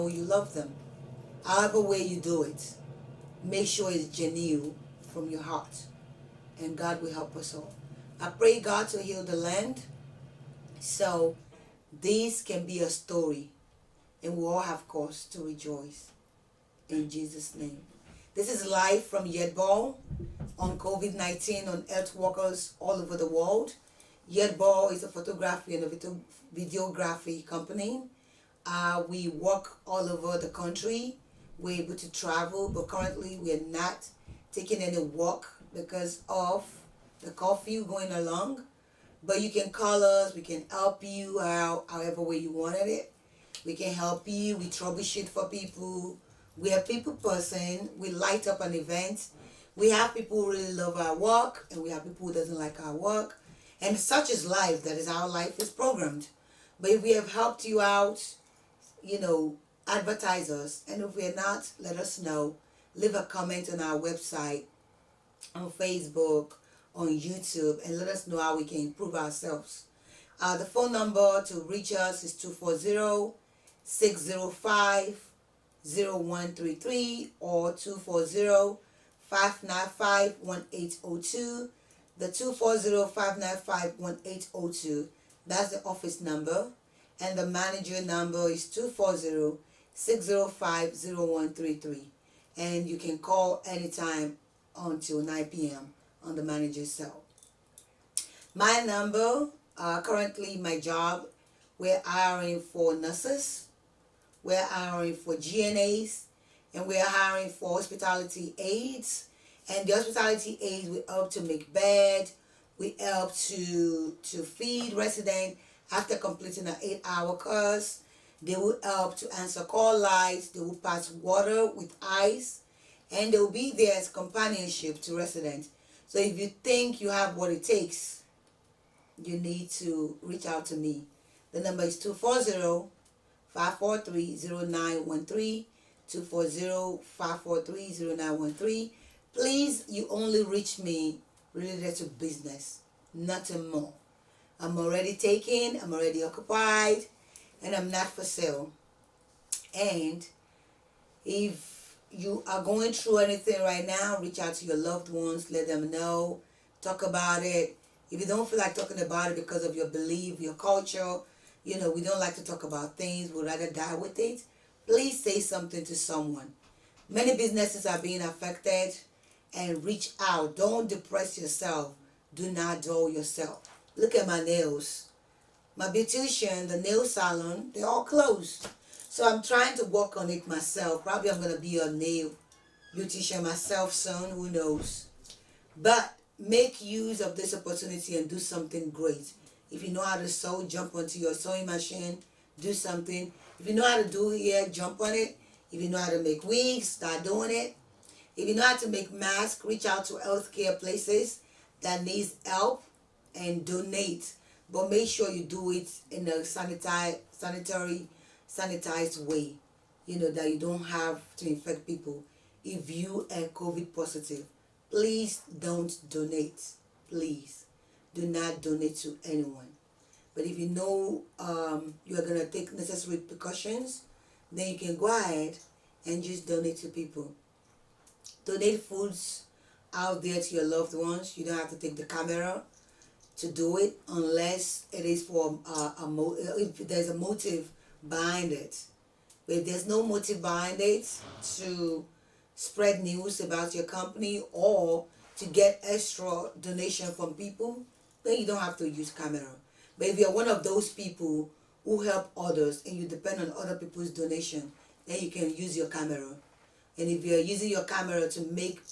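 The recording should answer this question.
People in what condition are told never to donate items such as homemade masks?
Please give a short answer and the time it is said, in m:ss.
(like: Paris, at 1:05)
COVID positive, at 3:33.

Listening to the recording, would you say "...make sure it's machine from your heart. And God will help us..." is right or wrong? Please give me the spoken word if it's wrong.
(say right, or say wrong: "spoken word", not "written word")
wrong: "genuine", not "machine".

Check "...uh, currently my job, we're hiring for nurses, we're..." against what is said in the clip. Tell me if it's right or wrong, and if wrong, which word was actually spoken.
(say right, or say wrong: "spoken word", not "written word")
right.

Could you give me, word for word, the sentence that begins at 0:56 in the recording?
But if we have helped you out, you know, advertise us.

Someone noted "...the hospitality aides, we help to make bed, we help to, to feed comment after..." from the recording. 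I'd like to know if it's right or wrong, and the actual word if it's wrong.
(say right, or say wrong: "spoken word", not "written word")
wrong: "resident", not "comment".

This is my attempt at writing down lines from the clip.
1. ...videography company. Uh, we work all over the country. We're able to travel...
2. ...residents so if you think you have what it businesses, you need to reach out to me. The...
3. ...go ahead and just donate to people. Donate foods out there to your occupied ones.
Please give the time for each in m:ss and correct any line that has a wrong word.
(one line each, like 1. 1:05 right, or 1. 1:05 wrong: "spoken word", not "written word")
1. 0:26 right
2. 2:05 wrong: "takes", not "businesses"
3. 3:44 wrong: "loved", not "occupied".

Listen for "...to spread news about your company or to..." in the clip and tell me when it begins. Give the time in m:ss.
4:01.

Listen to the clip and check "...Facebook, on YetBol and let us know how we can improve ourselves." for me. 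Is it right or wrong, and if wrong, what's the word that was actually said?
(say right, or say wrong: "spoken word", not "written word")
wrong: "YouTube", not "YetBol".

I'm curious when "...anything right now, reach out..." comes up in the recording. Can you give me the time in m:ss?
2:33.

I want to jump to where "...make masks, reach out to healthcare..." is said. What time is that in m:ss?
3:18.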